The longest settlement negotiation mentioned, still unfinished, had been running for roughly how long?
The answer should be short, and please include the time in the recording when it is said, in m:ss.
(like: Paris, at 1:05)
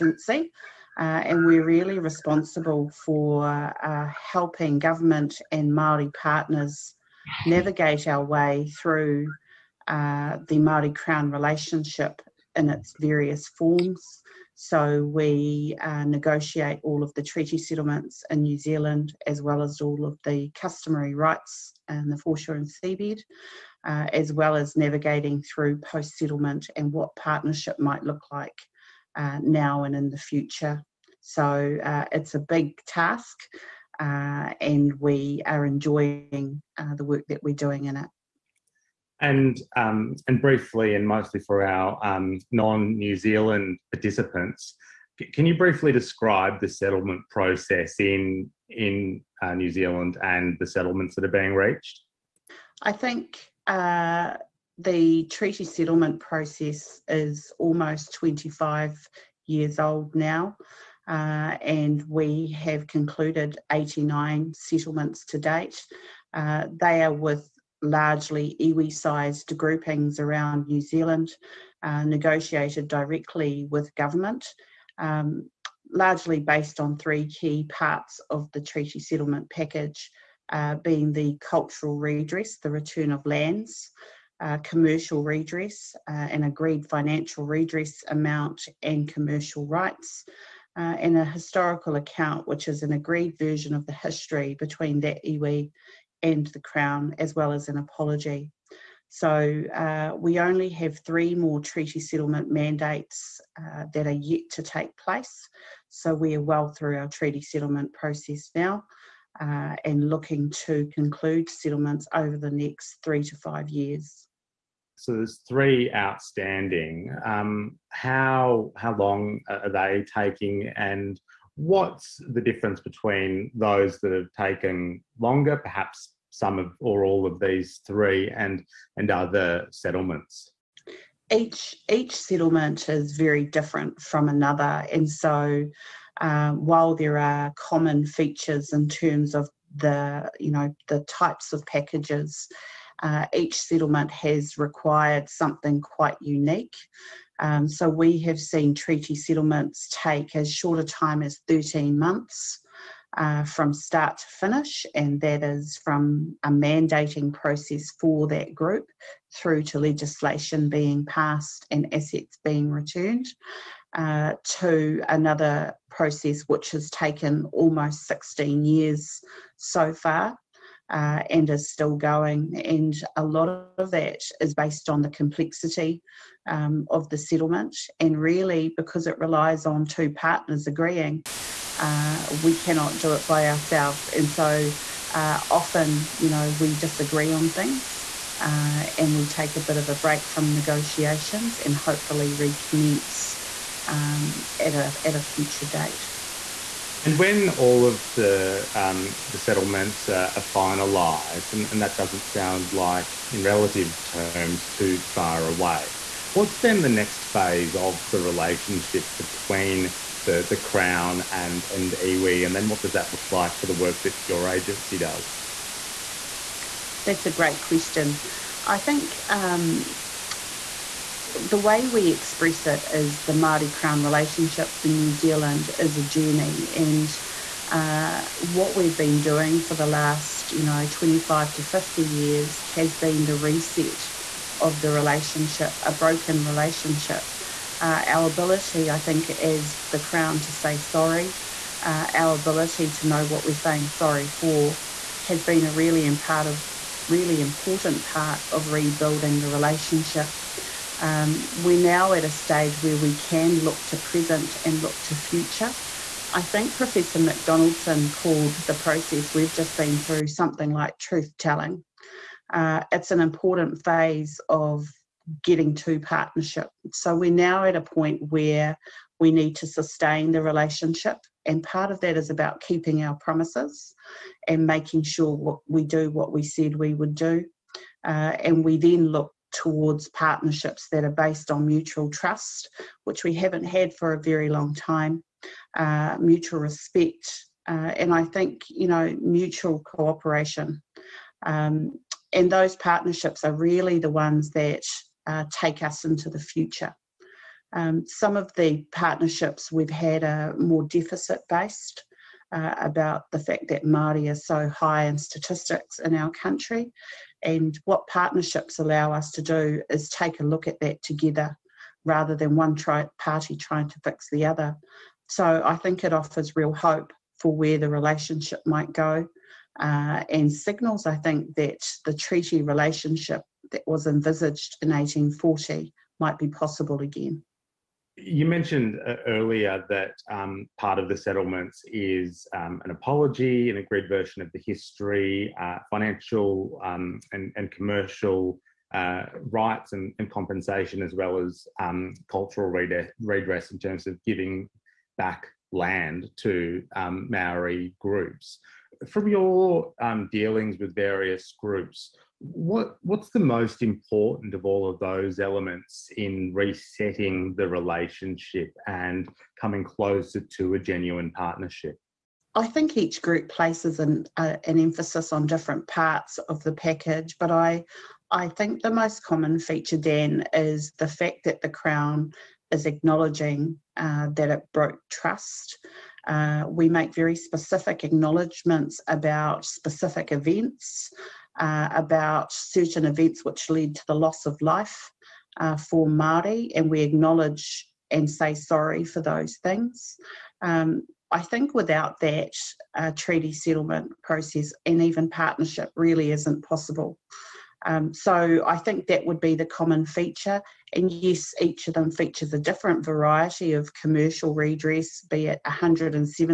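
Almost 16 years, at 2:47.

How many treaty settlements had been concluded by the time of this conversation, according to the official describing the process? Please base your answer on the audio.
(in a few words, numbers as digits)
89.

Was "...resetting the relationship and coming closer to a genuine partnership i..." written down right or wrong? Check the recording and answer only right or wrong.
right.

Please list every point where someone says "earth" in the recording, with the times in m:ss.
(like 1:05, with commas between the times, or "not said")
not said.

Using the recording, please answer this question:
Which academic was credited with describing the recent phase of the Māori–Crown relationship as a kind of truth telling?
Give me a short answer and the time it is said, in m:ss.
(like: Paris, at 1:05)
Professor McDonaldson, at 4:16.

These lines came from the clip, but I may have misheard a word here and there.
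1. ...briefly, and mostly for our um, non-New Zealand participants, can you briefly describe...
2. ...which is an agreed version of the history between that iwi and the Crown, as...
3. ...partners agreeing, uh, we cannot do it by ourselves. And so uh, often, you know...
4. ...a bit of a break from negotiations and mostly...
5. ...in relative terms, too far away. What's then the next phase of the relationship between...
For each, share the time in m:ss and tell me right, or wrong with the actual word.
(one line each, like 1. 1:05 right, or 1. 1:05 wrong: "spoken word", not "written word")
1. 0:40 right
2. 1:32 right
3. 3:00 right
4. 3:09 wrong: "hopefully", not "mostly"
5. 3:23 right.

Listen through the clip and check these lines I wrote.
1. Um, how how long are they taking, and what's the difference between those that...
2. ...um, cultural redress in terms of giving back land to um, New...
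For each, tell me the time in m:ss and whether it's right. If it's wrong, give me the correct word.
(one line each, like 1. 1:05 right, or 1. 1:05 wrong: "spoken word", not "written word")
1. 1:57 right
2. 5:41 wrong: "Maori", not "New".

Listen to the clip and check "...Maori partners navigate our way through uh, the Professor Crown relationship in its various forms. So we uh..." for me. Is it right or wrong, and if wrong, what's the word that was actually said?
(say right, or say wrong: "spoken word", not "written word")
wrong: "Māori", not "Professor".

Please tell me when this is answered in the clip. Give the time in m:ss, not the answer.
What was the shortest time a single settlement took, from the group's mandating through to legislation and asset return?
2:31.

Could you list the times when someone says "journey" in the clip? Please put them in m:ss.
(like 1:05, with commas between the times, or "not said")
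3:46.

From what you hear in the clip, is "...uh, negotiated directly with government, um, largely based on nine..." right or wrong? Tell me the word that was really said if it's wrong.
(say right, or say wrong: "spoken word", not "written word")
wrong: "three", not "nine".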